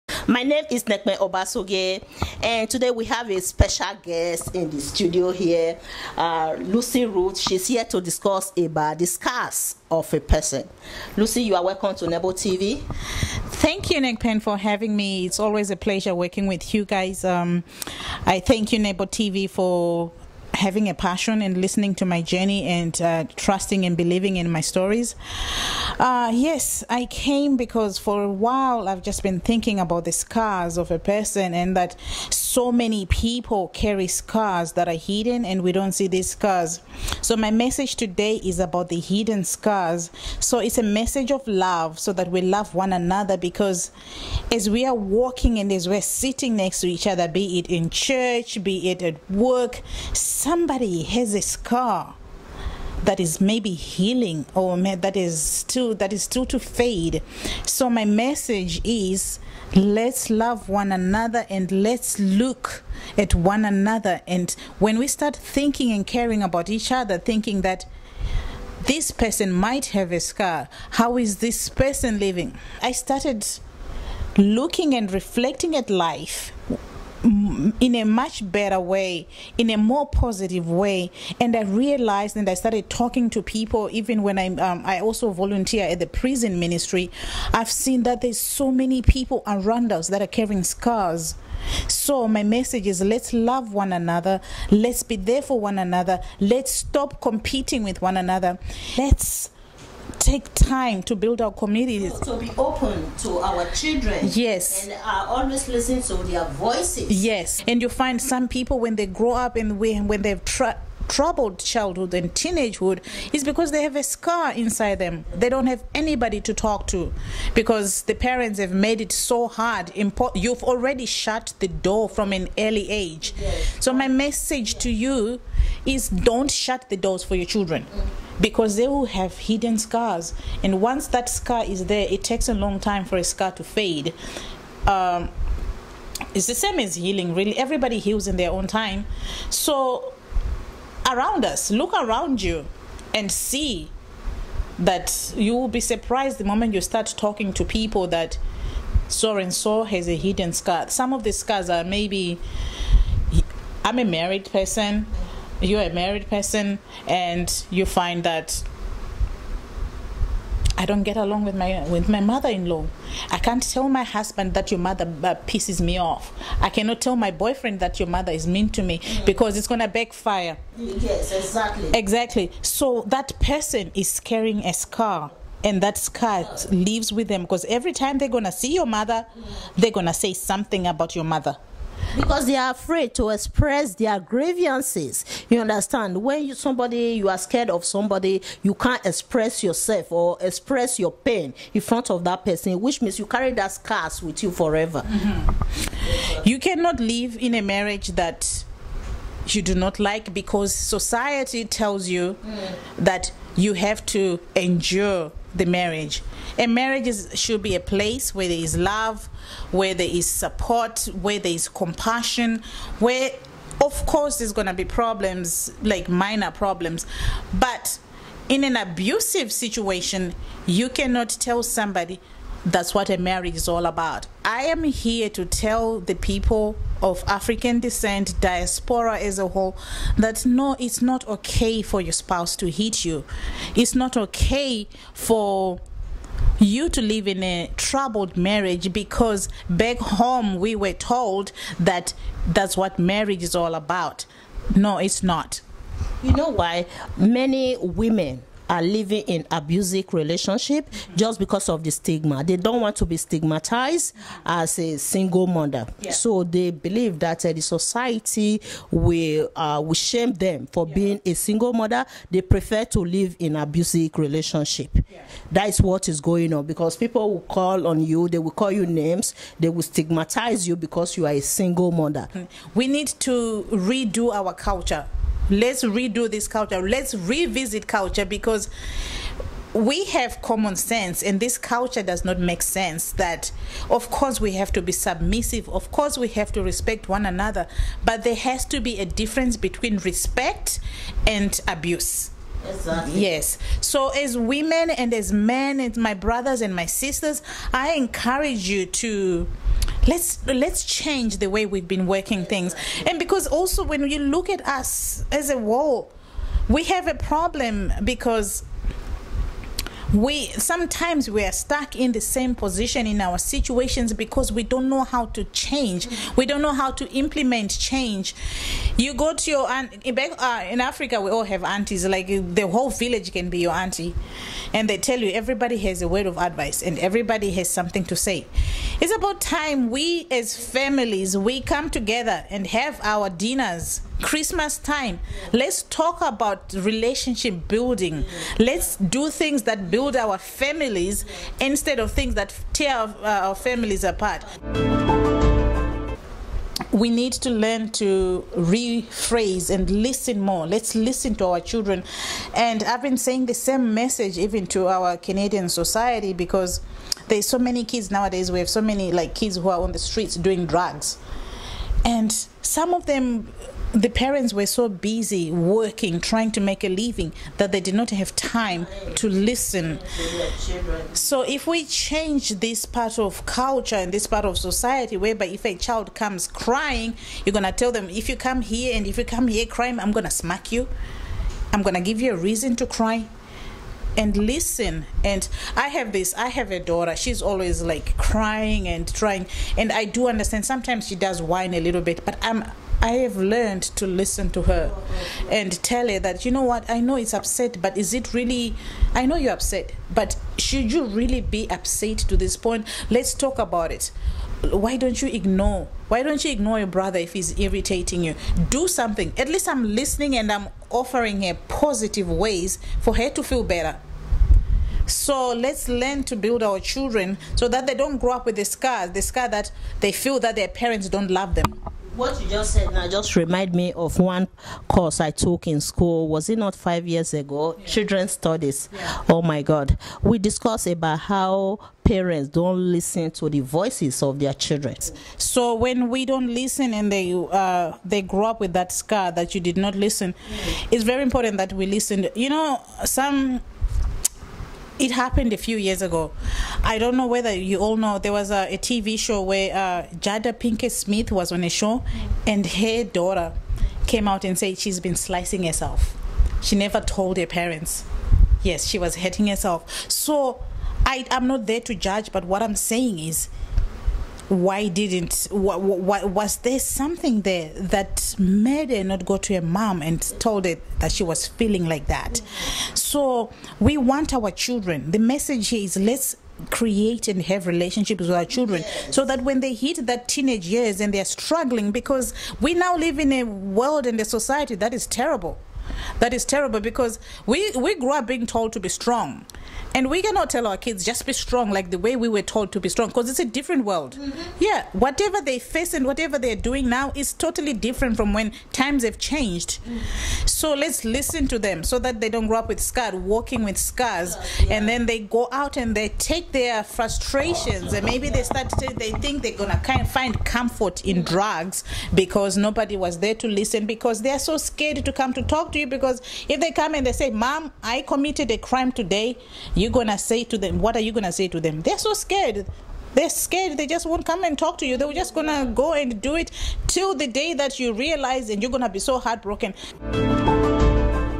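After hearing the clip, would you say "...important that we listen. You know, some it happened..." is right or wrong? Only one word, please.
right.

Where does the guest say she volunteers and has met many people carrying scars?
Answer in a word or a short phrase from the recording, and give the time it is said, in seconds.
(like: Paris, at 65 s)
prison ministry, at 86 s.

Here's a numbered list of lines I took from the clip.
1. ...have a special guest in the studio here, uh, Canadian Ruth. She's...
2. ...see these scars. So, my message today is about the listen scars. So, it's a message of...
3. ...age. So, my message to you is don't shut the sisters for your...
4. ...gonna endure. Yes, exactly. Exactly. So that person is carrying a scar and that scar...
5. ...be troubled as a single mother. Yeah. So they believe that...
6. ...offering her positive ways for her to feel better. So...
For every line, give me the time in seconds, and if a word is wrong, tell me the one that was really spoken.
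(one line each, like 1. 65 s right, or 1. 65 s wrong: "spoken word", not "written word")
1. 3 s wrong: "Lucy", not "Canadian"
2. 35 s wrong: "hidden", not "listen"
3. 122 s wrong: "doors", not "sisters"
4. 169 s wrong: "backfire", not "endure"
5. 253 s wrong: "stigmatized", not "troubled"
6. 410 s right.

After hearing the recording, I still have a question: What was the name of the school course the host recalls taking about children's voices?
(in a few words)
Children's studies.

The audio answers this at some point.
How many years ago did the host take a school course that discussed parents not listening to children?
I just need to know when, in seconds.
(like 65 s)
426 s.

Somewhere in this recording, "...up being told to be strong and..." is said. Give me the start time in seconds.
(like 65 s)
488 s.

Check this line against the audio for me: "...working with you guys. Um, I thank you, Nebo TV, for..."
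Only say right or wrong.
right.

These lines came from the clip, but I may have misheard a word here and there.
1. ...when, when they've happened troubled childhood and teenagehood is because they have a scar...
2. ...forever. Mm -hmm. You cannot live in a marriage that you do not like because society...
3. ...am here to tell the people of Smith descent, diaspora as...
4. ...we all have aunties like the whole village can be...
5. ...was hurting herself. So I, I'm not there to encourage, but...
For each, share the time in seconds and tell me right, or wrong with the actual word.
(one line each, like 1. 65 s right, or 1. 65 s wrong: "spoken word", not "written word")
1. 109 s wrong: "tried", not "happened"
2. 194 s right
3. 224 s wrong: "African", not "Smith"
4. 321 s right
5. 458 s wrong: "judge", not "encourage".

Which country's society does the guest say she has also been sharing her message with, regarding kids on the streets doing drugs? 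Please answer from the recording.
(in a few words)
Canadian.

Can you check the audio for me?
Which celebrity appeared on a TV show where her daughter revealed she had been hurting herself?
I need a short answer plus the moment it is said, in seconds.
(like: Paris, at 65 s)
Jada Pinkett Smith, at 450 s.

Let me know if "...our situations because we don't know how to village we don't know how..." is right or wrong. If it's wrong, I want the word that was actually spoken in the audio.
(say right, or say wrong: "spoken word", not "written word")
wrong: "change", not "village".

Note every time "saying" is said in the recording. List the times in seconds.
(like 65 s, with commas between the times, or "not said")
353 s, 462 s.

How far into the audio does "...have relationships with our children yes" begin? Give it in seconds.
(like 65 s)
477 s.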